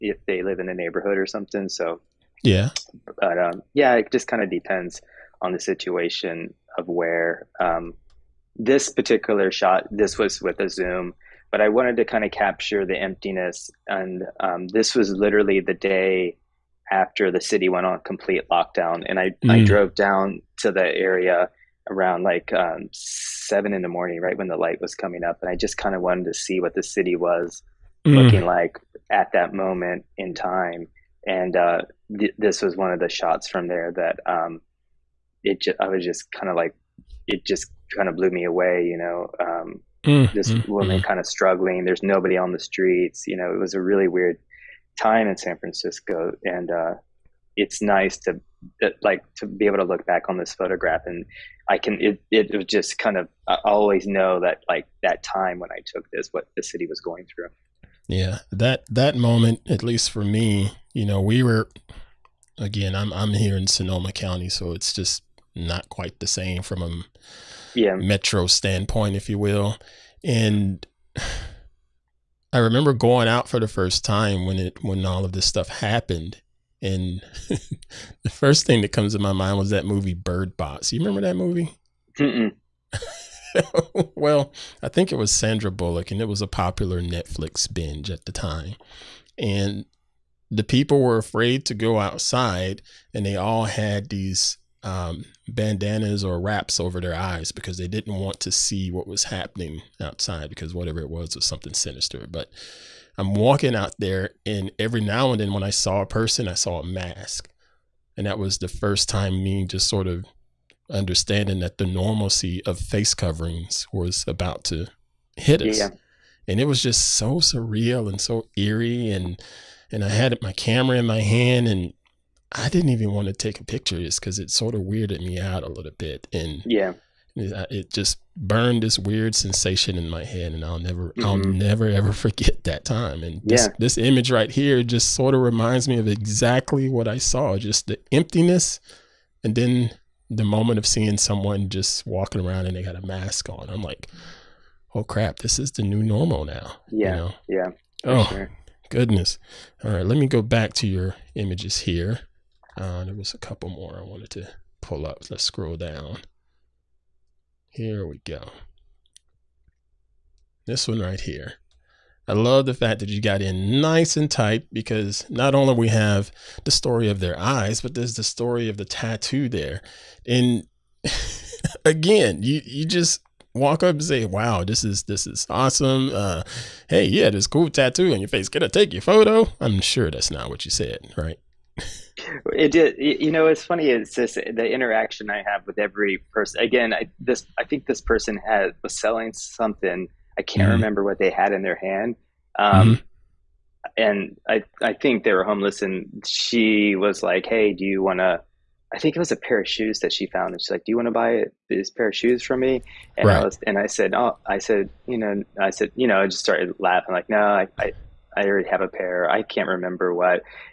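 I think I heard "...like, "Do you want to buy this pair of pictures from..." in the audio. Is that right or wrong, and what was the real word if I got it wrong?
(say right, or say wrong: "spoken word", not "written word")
wrong: "shoes", not "pictures".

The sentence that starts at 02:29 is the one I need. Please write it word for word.
All right, let me go back to your images here.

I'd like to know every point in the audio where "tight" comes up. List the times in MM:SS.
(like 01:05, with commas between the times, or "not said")
02:44.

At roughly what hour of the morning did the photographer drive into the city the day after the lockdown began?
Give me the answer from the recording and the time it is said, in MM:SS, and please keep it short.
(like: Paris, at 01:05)
7, at 00:22.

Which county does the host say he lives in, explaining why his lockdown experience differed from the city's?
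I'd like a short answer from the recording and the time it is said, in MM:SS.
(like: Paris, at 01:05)
Sonoma County, at 01:03.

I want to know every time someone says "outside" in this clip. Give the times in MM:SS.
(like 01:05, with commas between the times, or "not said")
01:32, 01:40.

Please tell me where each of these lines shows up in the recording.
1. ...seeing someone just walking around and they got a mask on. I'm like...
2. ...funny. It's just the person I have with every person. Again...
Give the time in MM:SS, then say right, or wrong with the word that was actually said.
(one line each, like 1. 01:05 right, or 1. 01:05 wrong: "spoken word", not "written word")
1. 02:20 right
2. 03:03 wrong: "interaction", not "person".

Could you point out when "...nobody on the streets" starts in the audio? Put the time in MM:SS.
00:42.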